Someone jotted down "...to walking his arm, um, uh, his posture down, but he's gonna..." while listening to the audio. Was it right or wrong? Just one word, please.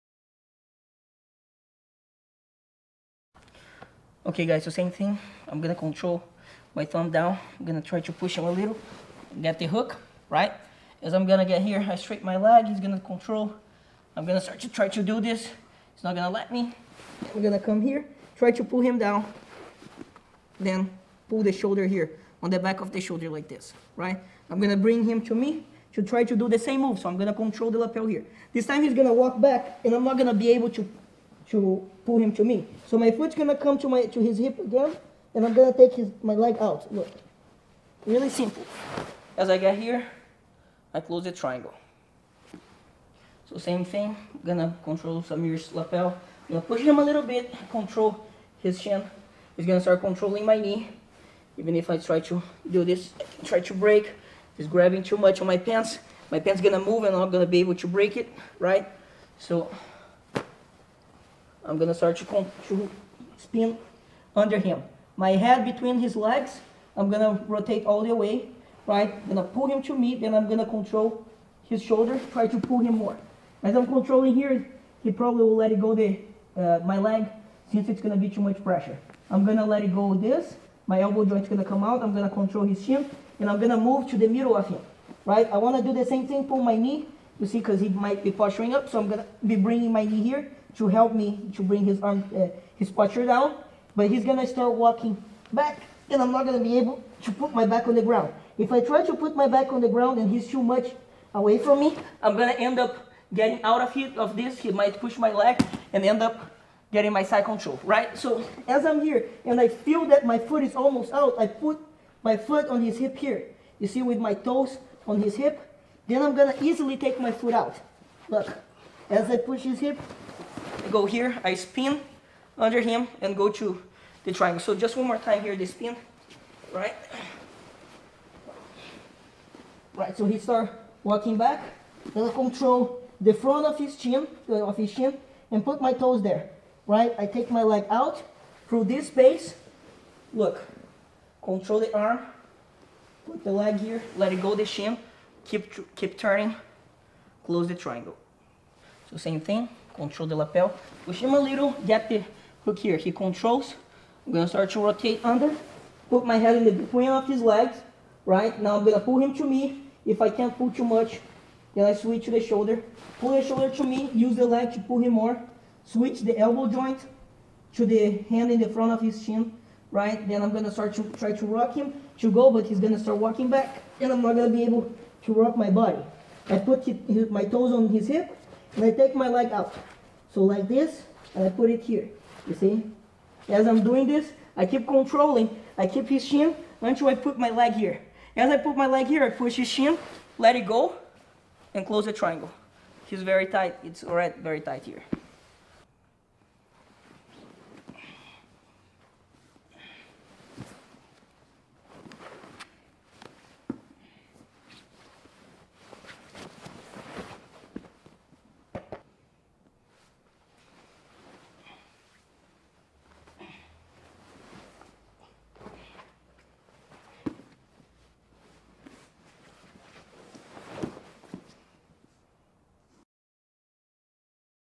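wrong.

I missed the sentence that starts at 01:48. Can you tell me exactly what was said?
So as I'm here and I feel that my foot is almost out, I put my foot on his hip here.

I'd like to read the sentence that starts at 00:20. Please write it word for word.
Then pull the shoulder here, on the back of the shoulder like this, right?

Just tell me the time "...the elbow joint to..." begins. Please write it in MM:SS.
02:46.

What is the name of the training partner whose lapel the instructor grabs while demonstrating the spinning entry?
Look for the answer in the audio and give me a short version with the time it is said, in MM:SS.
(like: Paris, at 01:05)
Samir, at 00:45.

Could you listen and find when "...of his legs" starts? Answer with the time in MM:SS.
02:37.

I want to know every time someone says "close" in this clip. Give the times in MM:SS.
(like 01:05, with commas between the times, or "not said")
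00:41, 02:27, 03:11.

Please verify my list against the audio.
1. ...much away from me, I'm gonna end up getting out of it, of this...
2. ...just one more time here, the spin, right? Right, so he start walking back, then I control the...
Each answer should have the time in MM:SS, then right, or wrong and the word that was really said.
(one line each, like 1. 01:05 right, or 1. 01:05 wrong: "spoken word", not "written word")
1. 01:40 right
2. 02:04 right.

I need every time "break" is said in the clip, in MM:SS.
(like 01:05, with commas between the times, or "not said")
00:53, 00:57.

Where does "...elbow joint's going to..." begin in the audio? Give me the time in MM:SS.
01:21.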